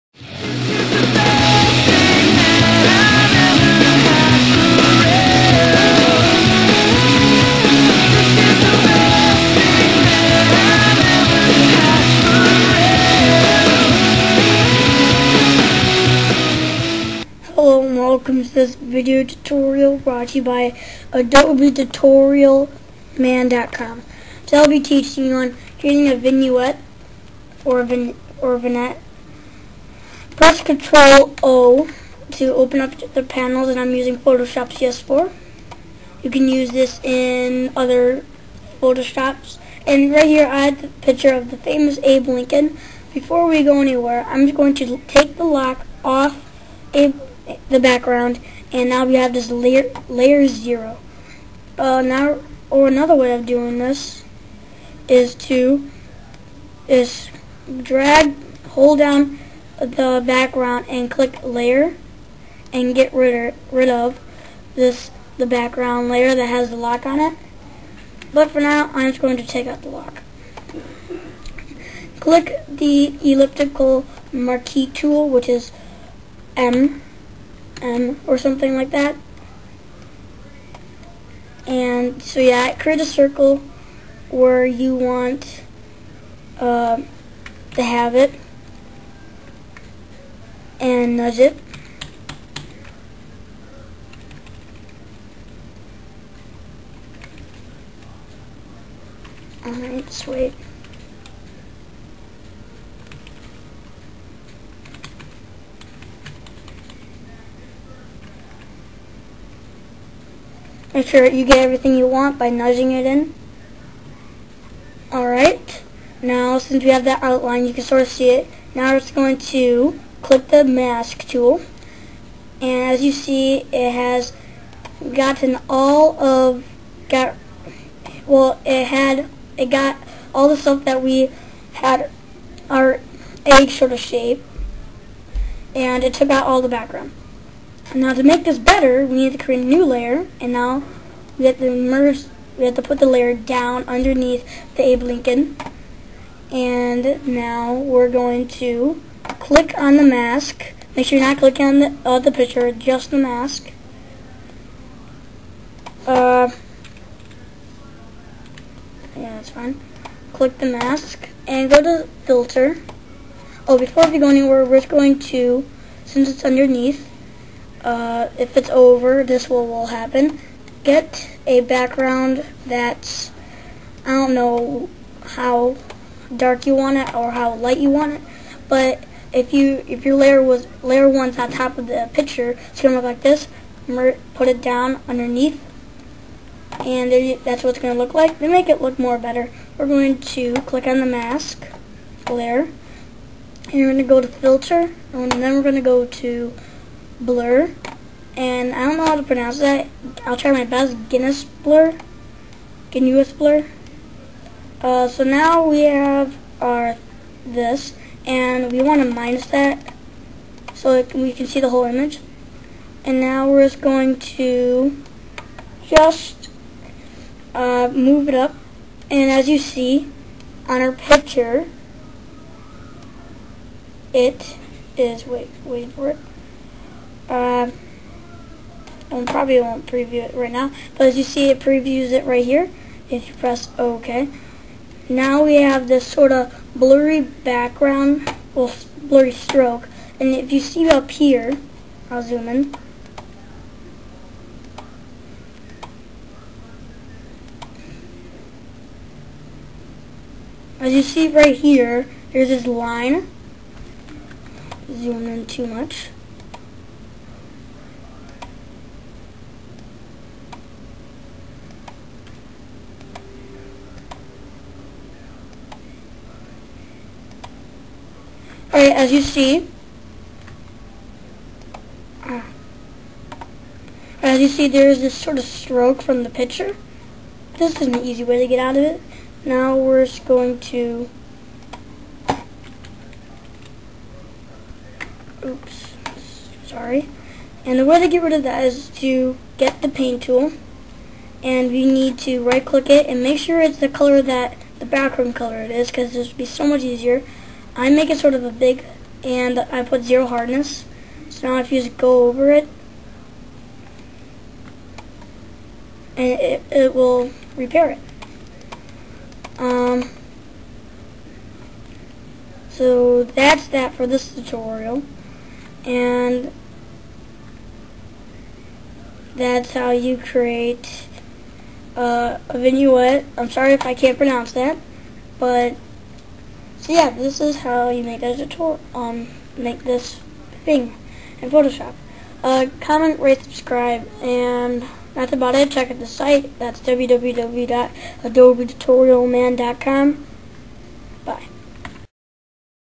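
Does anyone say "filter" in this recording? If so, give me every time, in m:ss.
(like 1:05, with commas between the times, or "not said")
2:42, 3:14.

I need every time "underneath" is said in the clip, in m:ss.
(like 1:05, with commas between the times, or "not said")
2:23, 2:46, 3:05.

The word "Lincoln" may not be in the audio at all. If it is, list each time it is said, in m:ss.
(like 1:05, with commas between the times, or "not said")
0:42, 2:25.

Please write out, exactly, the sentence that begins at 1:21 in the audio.
And so yeah, create a circle where you want uh, to have it and nudge it.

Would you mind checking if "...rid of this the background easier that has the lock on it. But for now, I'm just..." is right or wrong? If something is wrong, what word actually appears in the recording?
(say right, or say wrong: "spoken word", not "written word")
wrong: "layer", not "easier".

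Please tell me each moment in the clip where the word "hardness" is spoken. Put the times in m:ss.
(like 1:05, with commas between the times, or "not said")
5:00.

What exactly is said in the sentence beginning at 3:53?
If you press OK, now we have this sort of blurry background, well, blurry stroke.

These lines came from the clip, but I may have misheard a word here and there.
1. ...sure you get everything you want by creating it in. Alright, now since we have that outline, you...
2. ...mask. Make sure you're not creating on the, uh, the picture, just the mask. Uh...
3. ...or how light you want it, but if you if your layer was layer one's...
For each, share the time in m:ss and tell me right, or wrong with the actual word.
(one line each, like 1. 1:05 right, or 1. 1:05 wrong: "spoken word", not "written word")
1. 1:51 wrong: "nudging", not "creating"
2. 2:30 wrong: "clicking", not "creating"
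3. 2:57 right.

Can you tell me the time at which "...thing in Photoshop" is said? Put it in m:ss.
5:30.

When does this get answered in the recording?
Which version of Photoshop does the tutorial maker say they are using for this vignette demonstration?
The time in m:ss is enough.
0:34.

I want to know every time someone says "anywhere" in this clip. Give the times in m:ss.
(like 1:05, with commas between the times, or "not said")
0:43, 2:44.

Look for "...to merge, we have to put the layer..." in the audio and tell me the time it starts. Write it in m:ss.
2:21.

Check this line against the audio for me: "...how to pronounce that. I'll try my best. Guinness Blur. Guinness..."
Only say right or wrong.
right.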